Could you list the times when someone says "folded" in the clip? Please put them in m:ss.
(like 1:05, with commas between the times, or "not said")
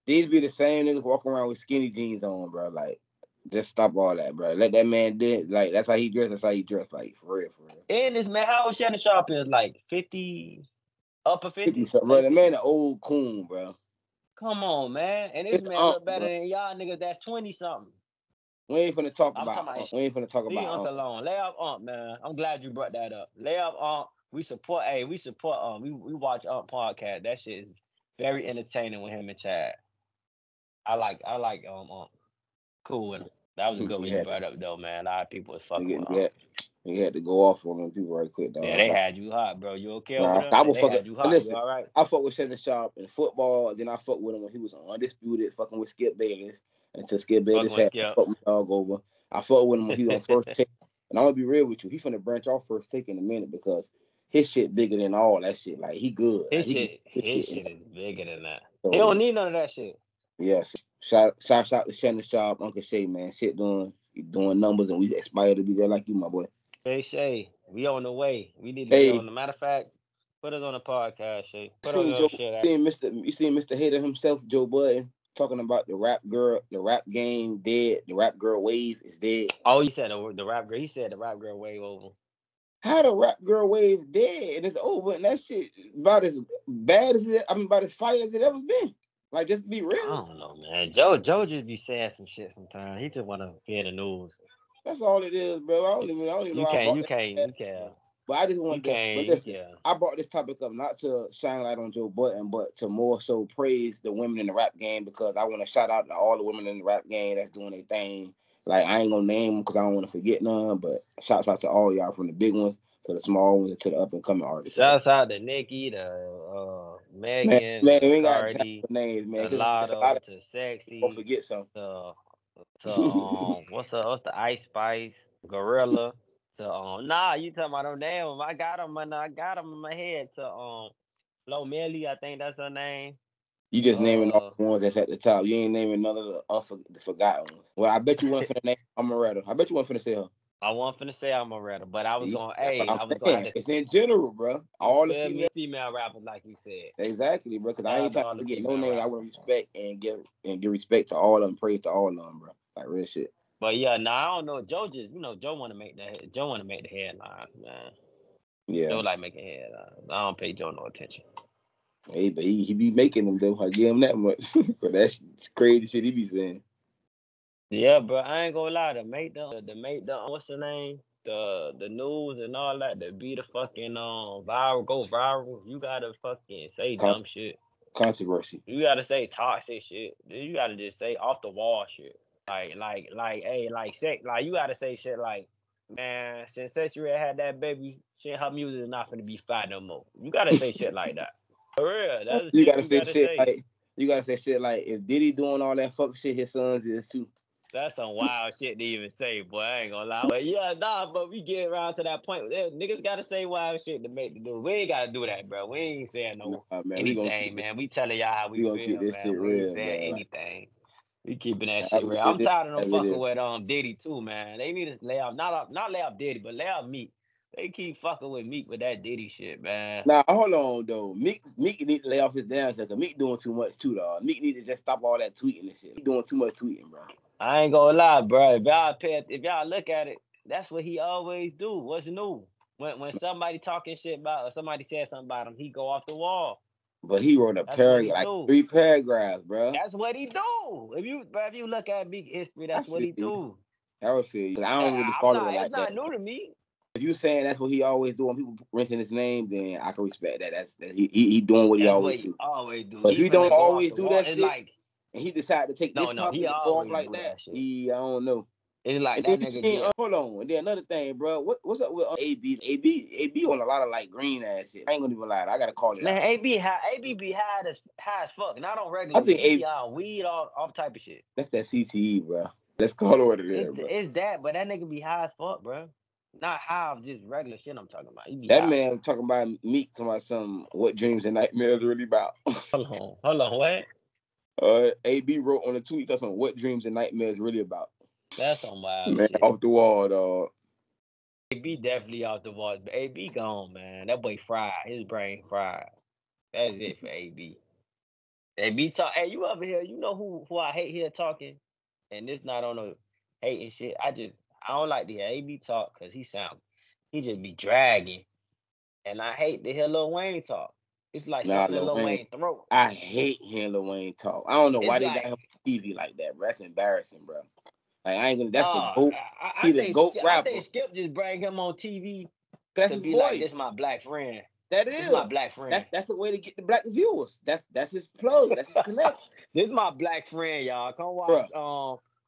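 not said.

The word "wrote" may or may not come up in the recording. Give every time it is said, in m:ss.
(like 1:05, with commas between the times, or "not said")
3:57, 4:45.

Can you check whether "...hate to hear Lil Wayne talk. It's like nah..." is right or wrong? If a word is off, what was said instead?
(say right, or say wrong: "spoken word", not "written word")
right.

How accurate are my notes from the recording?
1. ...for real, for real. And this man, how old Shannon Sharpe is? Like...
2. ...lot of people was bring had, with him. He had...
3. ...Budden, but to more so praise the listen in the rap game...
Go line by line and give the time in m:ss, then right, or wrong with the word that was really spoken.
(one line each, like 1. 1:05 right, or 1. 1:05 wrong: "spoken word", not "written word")
1. 0:07 right
2. 0:35 wrong: "fucking", not "bring"
3. 1:42 wrong: "women", not "listen".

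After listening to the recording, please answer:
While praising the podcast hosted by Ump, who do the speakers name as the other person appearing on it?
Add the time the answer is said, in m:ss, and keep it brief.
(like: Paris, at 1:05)
Chad, at 0:29.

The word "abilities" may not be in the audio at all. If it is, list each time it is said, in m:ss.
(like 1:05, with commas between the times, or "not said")
not said.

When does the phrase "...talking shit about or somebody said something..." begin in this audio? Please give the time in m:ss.
3:53.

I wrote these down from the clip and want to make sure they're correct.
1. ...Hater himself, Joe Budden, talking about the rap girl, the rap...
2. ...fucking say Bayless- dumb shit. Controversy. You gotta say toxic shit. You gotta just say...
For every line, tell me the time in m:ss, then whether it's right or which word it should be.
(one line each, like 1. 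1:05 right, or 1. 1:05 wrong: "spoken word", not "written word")
1. 1:13 right
2. 2:56 wrong: "Con", not "Bayless".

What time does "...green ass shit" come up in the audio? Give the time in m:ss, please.
4:24.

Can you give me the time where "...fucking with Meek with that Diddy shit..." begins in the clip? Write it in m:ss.
3:38.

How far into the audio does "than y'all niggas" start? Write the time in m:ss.
0:16.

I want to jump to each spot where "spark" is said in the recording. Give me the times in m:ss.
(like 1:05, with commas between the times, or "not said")
not said.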